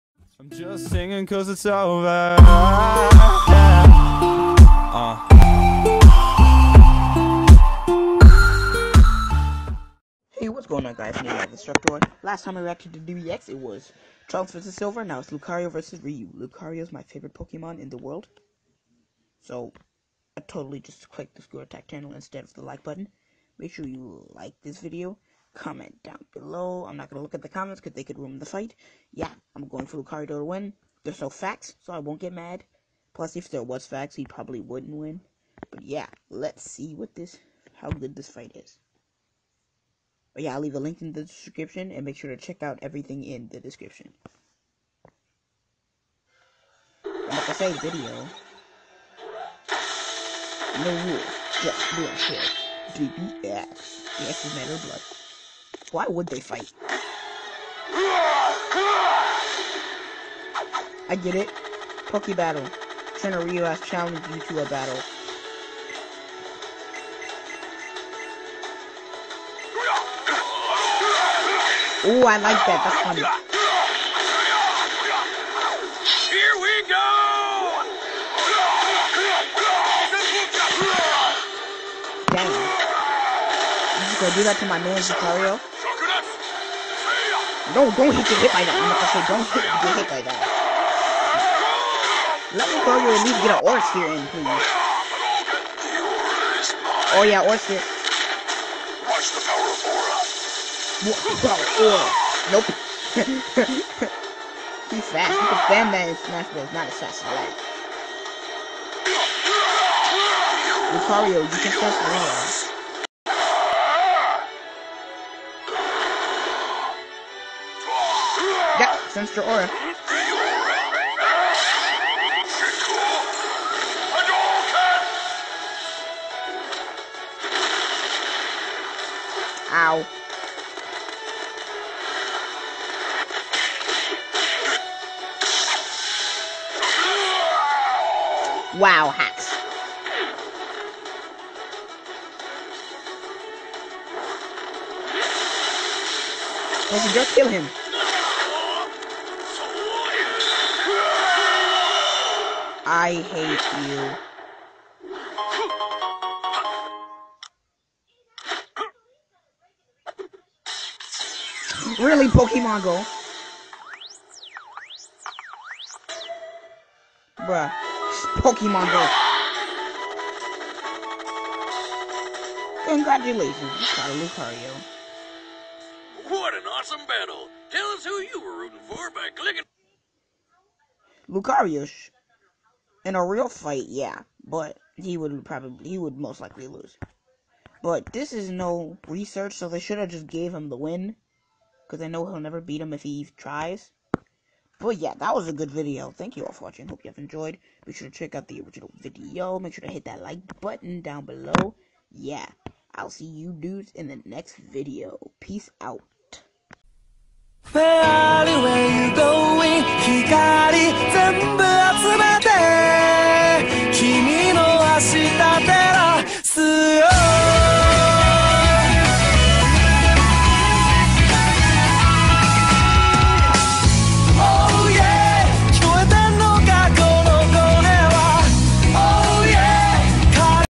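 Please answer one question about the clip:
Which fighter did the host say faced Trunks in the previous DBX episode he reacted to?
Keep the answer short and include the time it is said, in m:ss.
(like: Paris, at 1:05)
Silver, at 0:14.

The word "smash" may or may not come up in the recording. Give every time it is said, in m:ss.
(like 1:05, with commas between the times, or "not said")
1:46, 1:51.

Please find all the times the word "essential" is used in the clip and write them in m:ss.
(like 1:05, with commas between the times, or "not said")
not said.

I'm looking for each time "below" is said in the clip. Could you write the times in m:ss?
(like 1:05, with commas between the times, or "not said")
0:26, 3:21.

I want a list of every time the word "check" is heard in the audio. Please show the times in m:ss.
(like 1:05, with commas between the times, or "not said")
0:42, 3:18.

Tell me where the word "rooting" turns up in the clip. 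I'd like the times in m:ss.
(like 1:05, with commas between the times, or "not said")
2:58.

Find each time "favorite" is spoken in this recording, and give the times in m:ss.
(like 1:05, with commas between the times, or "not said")
0:17.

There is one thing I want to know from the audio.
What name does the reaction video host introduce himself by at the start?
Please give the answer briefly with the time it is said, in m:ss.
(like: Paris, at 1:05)
Destructor, at 0:11.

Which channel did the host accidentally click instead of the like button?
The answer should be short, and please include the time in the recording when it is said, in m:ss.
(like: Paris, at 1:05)
Screw Attack, at 0:21.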